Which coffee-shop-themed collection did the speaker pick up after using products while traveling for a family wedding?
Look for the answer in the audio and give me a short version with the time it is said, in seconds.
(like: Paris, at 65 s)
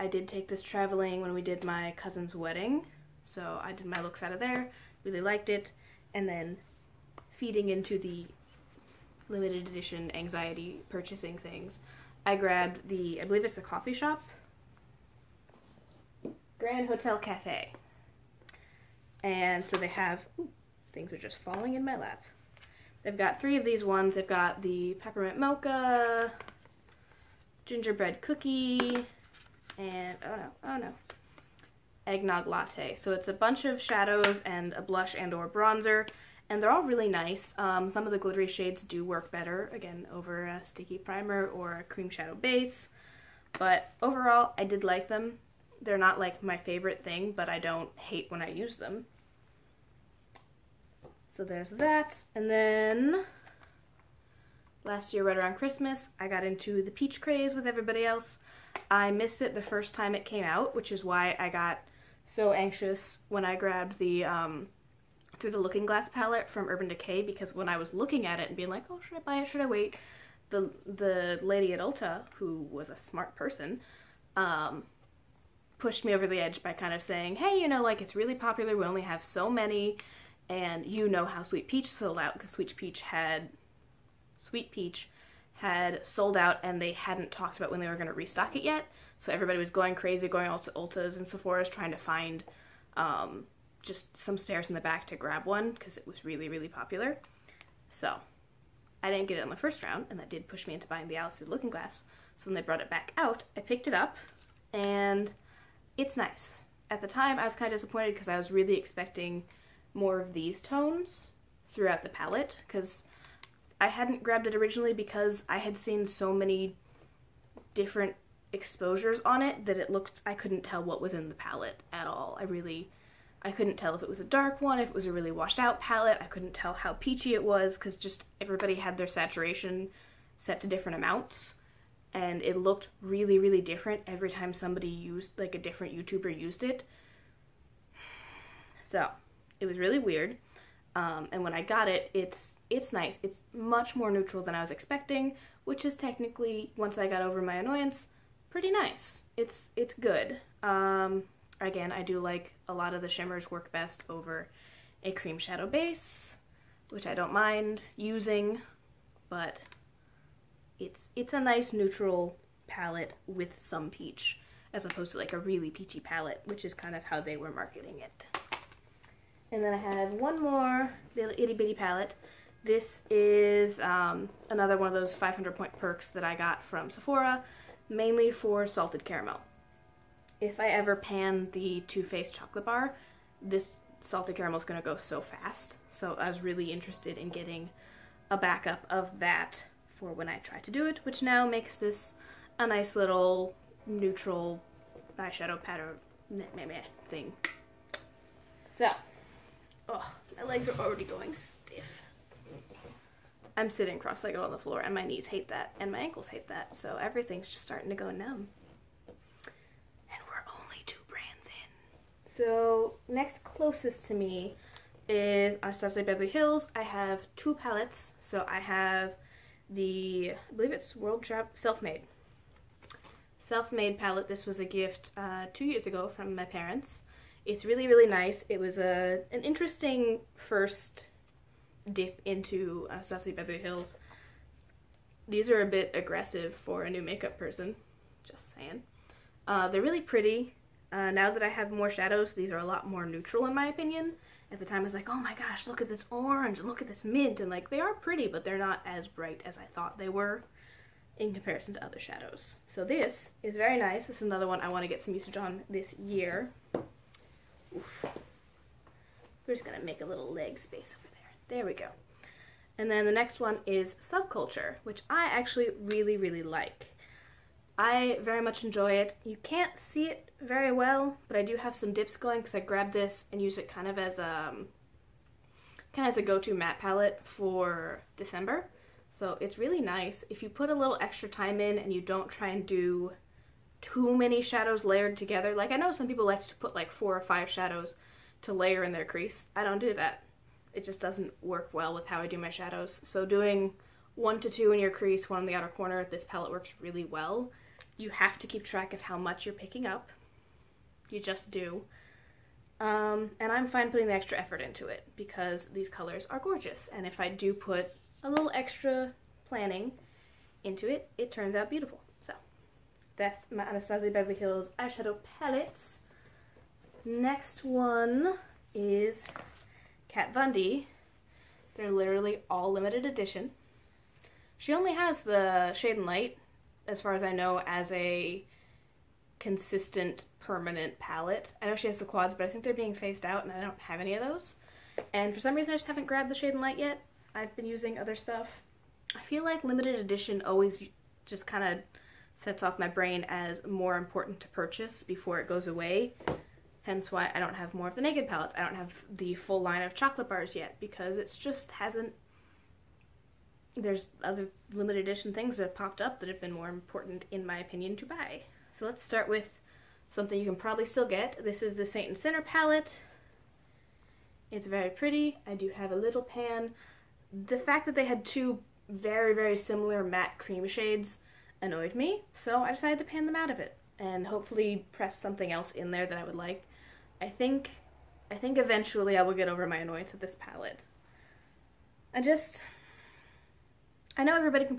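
Grand Hotel Cafe, at 16 s.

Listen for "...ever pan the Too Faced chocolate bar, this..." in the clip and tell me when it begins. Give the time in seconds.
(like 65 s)
180 s.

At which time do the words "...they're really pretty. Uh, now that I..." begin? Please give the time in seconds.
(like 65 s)
239 s.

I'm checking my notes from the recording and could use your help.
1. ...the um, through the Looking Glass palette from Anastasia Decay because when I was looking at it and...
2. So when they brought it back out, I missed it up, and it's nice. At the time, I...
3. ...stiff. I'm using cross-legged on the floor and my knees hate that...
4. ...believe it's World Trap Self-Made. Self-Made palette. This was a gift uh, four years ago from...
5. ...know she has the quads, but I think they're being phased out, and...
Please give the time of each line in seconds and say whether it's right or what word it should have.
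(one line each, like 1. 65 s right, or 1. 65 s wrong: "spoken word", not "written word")
1. 63 s wrong: "Urban", not "Anastasia"
2. 102 s wrong: "picked", not "missed"
3. 201 s wrong: "sitting", not "using"
4. 220 s wrong: "two", not "four"
5. 331 s right.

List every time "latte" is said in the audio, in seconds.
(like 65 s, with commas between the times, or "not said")
32 s.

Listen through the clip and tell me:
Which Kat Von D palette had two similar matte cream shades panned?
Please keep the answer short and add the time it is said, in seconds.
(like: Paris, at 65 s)
Saint and Sinner, at 361 s.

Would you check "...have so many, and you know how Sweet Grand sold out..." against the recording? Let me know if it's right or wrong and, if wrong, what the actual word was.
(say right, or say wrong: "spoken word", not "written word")
wrong: "Peach", not "Grand".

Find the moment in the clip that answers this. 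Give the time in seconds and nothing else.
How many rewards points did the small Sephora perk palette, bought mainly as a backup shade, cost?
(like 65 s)
175 s.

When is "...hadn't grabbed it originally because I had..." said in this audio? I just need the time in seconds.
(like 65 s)
113 s.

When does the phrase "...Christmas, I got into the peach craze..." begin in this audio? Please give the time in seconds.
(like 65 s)
55 s.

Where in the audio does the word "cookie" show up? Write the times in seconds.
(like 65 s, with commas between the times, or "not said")
28 s.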